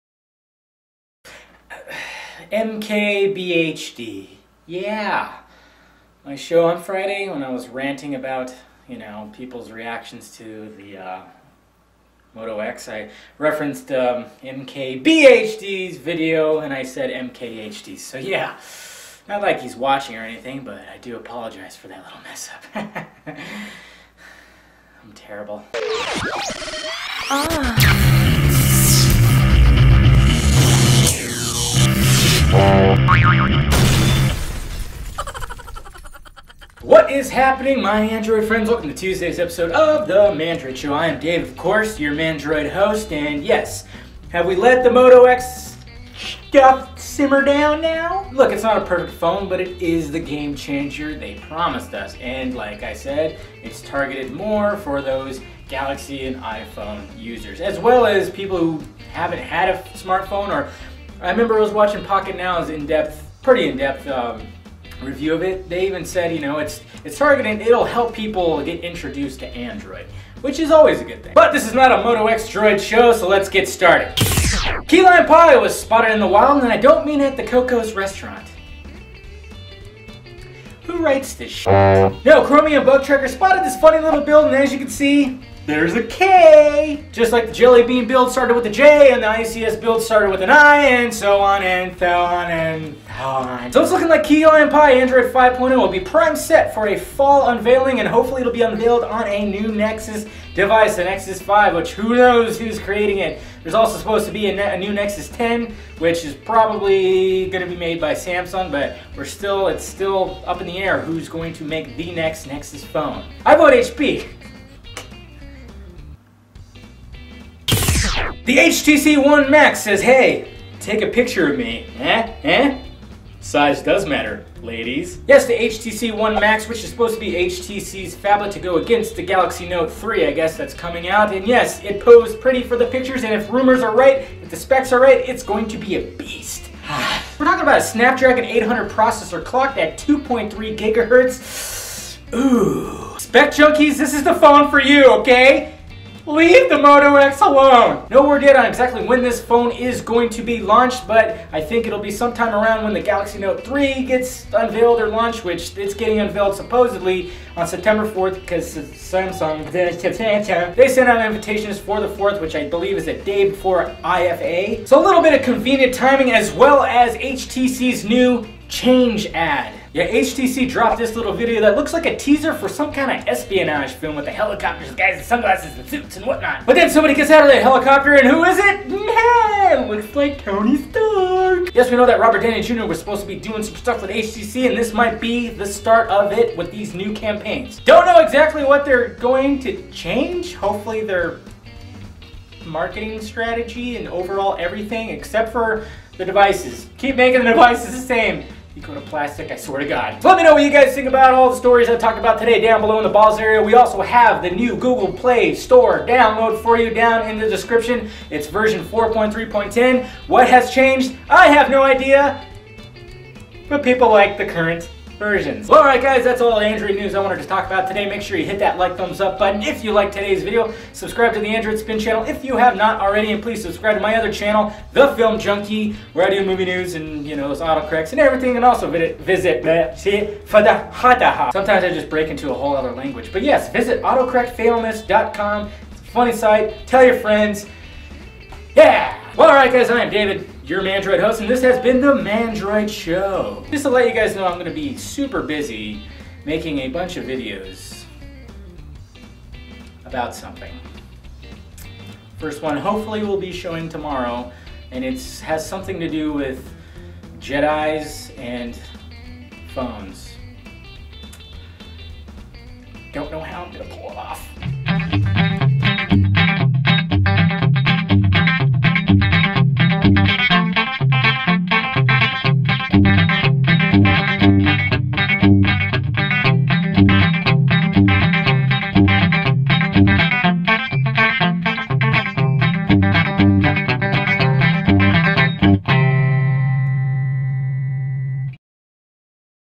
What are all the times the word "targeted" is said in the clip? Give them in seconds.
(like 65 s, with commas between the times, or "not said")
53 s, 67 s.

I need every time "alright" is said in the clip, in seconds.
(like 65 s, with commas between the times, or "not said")
215 s, 239 s.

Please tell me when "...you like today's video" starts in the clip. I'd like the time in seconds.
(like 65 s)
219 s.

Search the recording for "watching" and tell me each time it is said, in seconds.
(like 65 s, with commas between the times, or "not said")
19 s, 61 s.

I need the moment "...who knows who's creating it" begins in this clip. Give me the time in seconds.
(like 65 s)
101 s.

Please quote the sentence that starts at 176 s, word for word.
But then somebody gets out of that helicopter and who is it?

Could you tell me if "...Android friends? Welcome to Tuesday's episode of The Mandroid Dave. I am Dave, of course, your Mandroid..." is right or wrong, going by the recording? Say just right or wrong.
wrong.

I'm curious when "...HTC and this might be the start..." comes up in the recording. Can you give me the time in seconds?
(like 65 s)
184 s.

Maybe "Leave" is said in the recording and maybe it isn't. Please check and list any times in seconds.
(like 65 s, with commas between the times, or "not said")
146 s.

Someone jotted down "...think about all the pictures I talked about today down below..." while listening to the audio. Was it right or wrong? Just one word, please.
wrong.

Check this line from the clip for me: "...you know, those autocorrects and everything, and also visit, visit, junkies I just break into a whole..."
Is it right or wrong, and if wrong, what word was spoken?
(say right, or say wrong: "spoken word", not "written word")
wrong: "sometimes", not "junkies".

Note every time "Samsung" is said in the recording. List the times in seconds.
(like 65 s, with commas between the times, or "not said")
108 s, 158 s.